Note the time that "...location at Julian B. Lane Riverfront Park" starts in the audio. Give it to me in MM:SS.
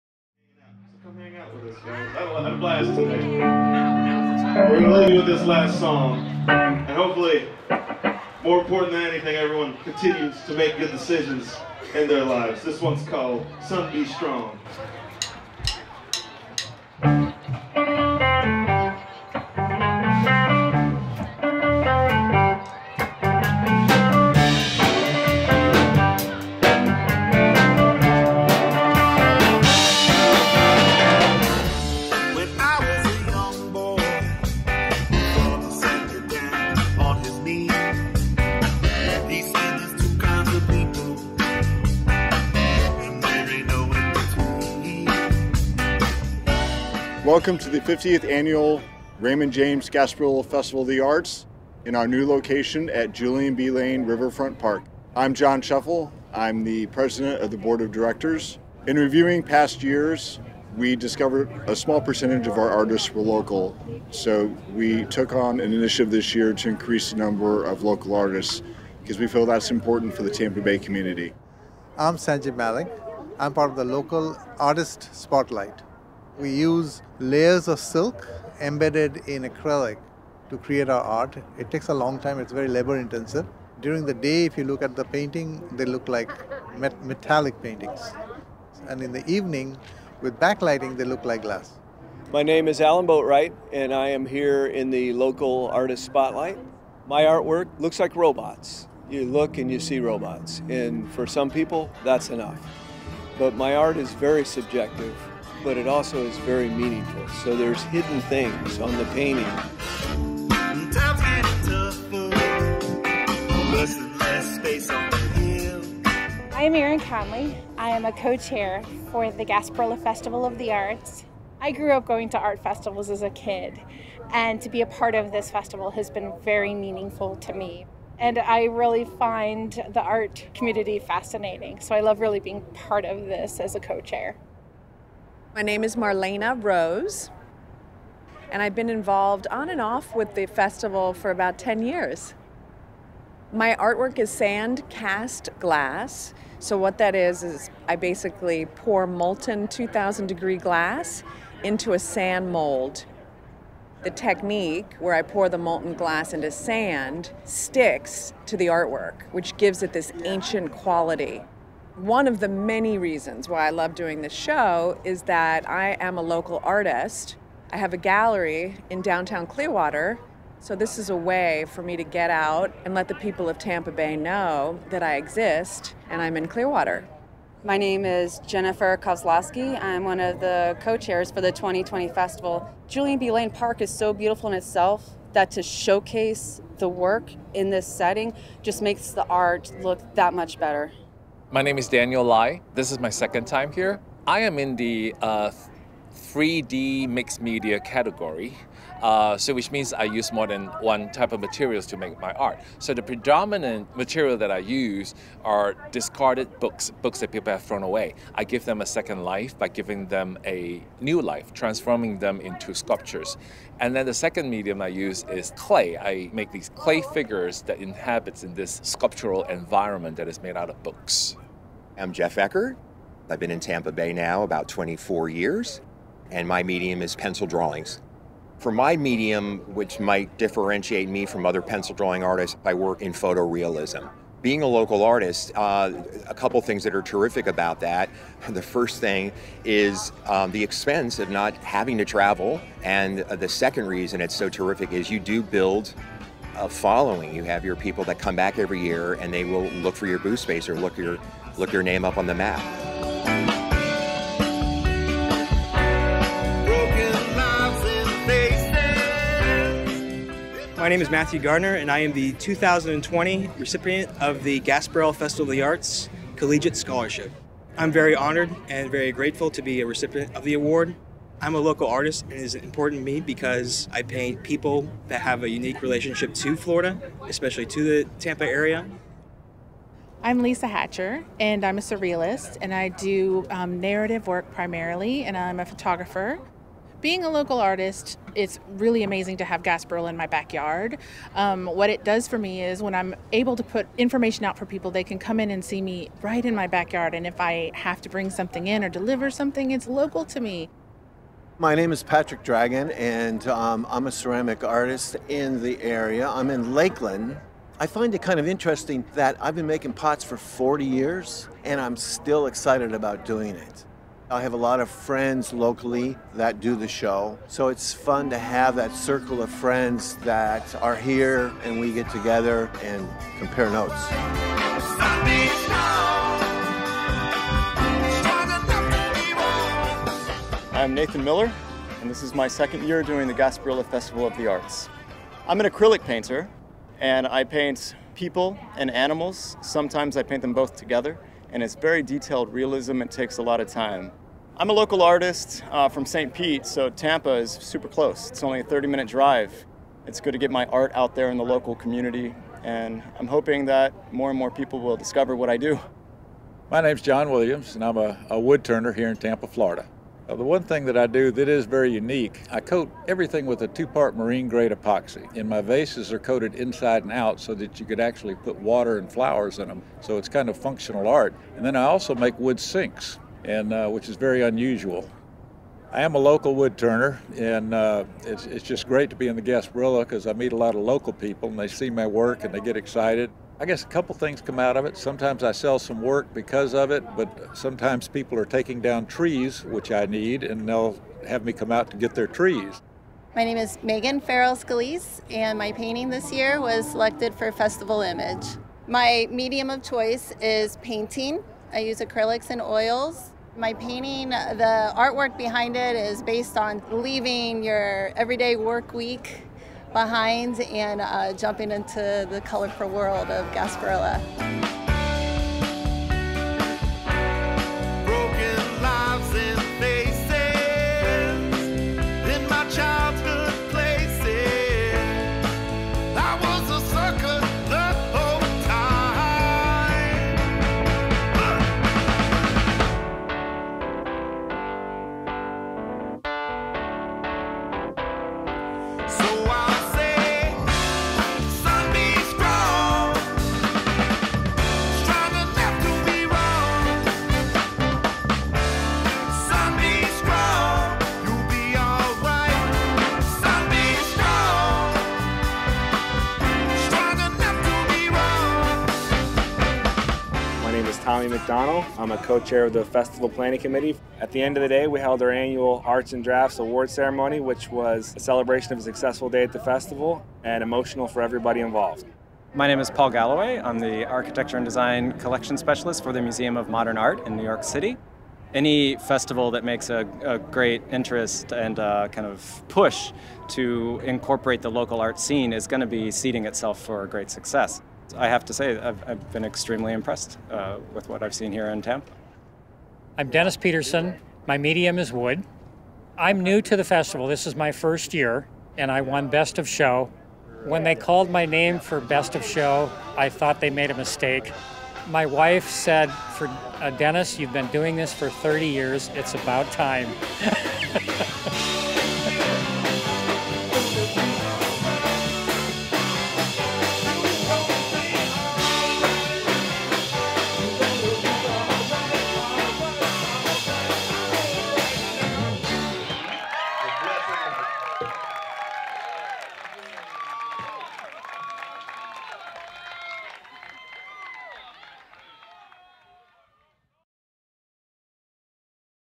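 00:52.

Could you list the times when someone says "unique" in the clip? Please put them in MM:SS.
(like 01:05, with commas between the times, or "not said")
04:35, 06:01.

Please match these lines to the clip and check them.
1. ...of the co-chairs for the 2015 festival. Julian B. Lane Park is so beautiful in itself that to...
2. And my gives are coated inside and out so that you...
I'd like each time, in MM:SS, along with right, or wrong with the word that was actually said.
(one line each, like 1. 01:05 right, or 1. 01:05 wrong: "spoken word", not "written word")
1. 03:00 wrong: "2020", not "2015"
2. 06:05 wrong: "vases", not "gives".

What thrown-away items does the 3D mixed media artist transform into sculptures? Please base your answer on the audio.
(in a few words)
Discarded books.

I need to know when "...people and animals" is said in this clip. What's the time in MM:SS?
05:38.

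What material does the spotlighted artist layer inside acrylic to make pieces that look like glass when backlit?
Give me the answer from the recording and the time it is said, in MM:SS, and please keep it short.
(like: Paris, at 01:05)
Silk, at 01:17.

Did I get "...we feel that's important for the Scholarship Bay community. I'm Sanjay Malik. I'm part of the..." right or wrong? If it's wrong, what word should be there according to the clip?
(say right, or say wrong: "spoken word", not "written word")
wrong: "Tampa", not "Scholarship".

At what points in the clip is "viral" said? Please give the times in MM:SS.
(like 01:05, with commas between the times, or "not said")
not said.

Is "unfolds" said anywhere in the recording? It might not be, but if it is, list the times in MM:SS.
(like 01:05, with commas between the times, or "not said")
not said.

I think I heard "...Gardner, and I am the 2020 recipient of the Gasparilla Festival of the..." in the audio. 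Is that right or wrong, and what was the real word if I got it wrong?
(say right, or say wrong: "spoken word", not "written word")
right.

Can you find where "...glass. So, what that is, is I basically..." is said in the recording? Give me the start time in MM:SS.
02:25.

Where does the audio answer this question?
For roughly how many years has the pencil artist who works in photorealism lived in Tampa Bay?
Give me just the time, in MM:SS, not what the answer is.
03:44.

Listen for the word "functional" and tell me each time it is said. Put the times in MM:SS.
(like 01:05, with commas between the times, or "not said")
06:10.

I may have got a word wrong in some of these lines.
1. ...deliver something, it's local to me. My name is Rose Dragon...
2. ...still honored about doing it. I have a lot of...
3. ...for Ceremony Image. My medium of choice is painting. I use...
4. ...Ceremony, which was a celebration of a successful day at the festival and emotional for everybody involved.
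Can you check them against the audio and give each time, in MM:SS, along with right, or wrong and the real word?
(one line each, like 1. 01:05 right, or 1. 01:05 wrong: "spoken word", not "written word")
1. 04:58 wrong: "Patrick", not "Rose"
2. 05:11 wrong: "excited", not "honored"
3. 06:37 wrong: "Festival", not "Ceremony"
4. 07:46 right.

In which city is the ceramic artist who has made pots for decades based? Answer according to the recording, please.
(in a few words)
Lakeland.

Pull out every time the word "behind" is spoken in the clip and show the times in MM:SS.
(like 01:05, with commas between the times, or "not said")
06:45, 06:49.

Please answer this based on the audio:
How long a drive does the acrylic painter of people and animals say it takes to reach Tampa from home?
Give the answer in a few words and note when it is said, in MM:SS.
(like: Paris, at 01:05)
30 minutes, at 05:48.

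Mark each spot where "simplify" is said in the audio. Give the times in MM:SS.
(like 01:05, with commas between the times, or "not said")
not said.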